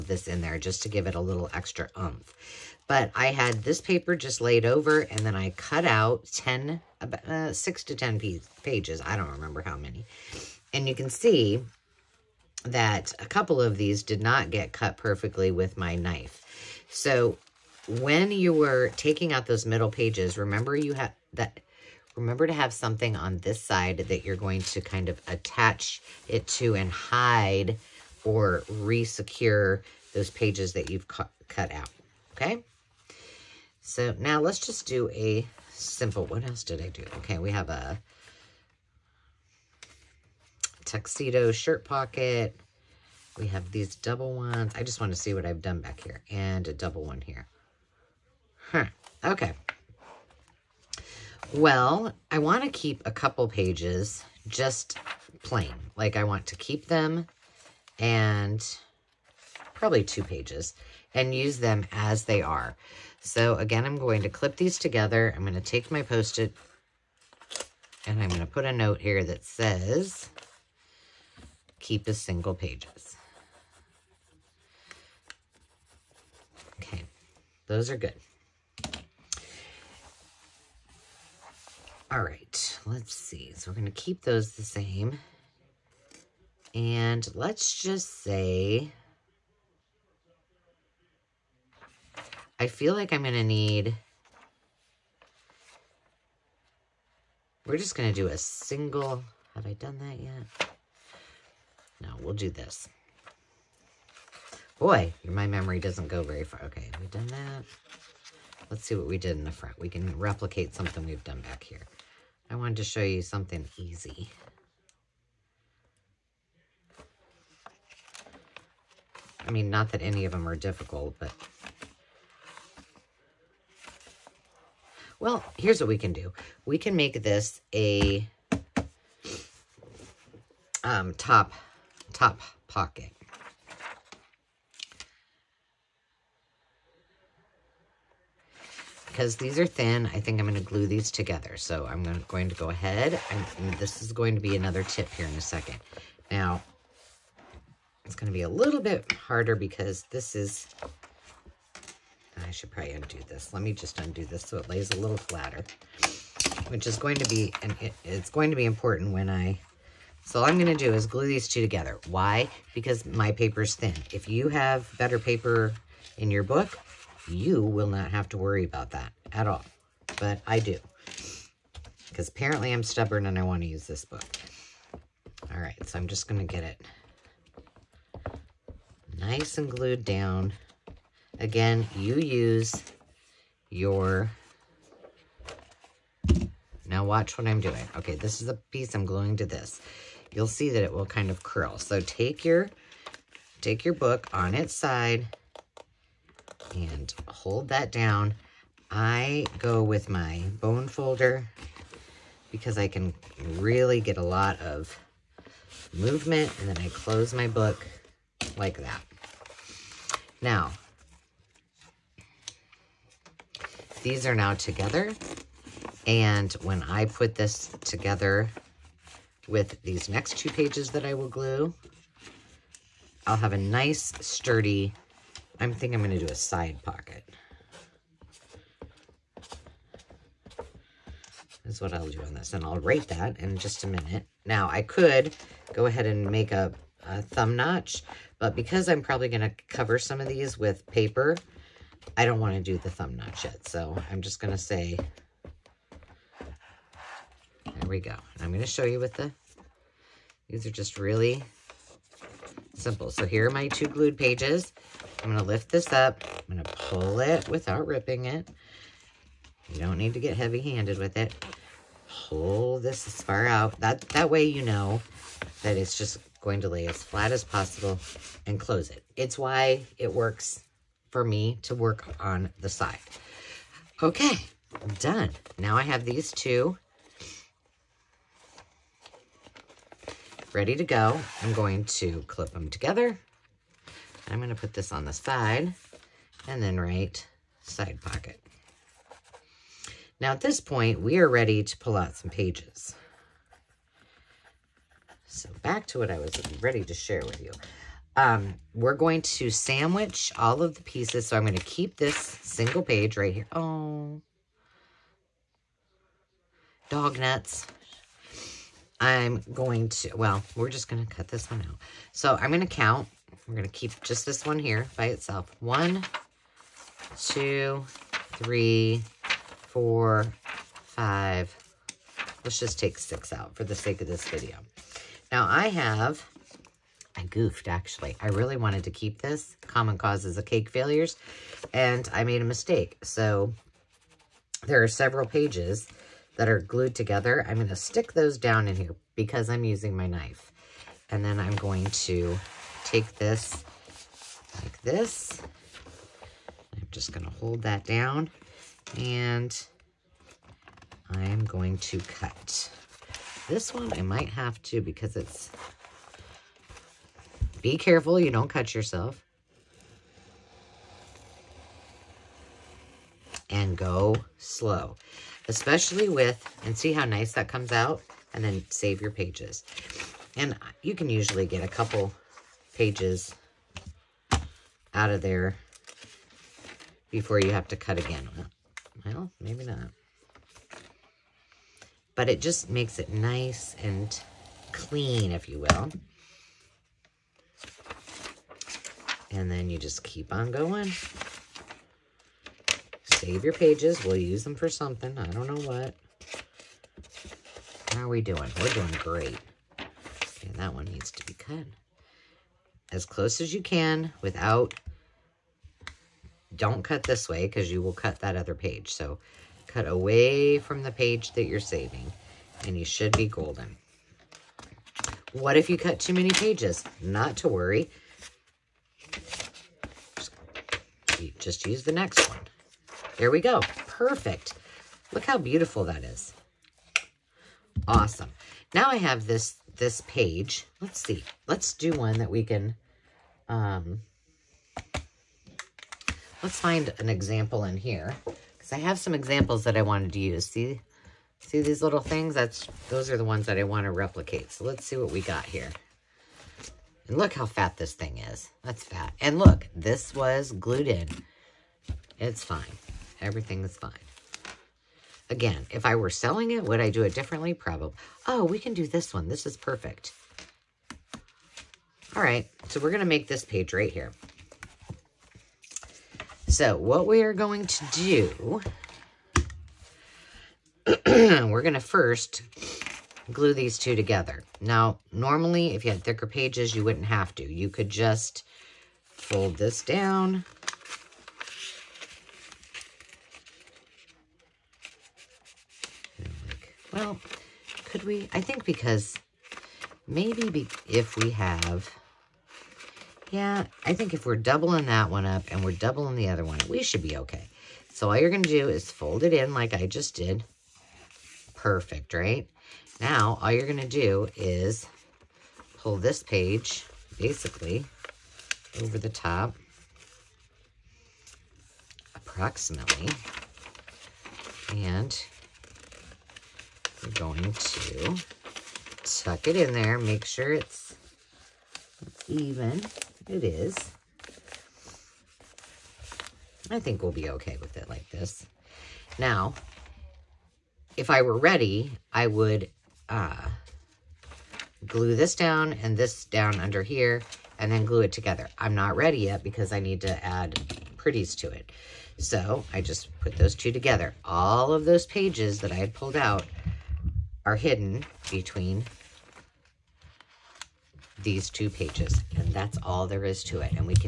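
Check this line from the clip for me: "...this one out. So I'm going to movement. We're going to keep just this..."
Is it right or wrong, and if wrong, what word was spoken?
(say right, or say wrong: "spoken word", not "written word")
wrong: "count", not "movement".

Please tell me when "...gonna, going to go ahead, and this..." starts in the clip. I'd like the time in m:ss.
2:22.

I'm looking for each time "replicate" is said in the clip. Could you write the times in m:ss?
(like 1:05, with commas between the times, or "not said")
1:50, 7:23.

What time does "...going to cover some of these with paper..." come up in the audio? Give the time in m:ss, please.
3:59.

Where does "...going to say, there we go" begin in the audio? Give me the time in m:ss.
4:04.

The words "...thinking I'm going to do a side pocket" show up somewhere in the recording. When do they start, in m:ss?
3:45.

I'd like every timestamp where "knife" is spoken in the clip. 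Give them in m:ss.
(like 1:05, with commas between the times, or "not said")
0:15, 5:40.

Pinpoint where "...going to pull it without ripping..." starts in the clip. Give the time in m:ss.
4:16.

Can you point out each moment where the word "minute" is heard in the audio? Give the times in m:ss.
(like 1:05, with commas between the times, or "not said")
3:53.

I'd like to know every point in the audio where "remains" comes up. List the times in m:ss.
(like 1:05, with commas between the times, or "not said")
not said.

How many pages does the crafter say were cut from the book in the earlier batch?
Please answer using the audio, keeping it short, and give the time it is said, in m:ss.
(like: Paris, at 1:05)
6 to 10, at 0:07.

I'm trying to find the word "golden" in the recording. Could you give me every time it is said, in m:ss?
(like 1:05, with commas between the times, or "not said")
6:53.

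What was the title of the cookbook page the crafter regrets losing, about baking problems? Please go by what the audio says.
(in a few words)
Common causes of cake failures.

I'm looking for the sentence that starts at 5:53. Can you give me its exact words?
This one I might have to because it's...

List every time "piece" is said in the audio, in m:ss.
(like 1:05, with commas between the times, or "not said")
3:08, 5:00.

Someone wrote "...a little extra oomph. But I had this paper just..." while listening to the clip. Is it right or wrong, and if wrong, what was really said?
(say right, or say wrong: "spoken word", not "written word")
right.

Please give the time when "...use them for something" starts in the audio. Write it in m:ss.
6:34.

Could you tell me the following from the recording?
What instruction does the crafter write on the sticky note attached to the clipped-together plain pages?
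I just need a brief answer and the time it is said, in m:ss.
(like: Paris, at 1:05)
keep as single pages, at 1:11.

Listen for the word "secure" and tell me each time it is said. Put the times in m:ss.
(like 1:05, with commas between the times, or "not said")
0:28.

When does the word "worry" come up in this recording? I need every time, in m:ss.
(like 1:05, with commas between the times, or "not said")
2:48, 6:57.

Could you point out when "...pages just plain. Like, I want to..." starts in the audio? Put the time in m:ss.
0:53.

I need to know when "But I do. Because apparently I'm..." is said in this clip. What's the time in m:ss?
2:50.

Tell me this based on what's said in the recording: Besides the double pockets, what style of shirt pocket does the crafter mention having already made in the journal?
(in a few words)
tuxedo.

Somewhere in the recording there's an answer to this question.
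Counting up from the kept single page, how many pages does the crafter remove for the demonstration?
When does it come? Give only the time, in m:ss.
5:22.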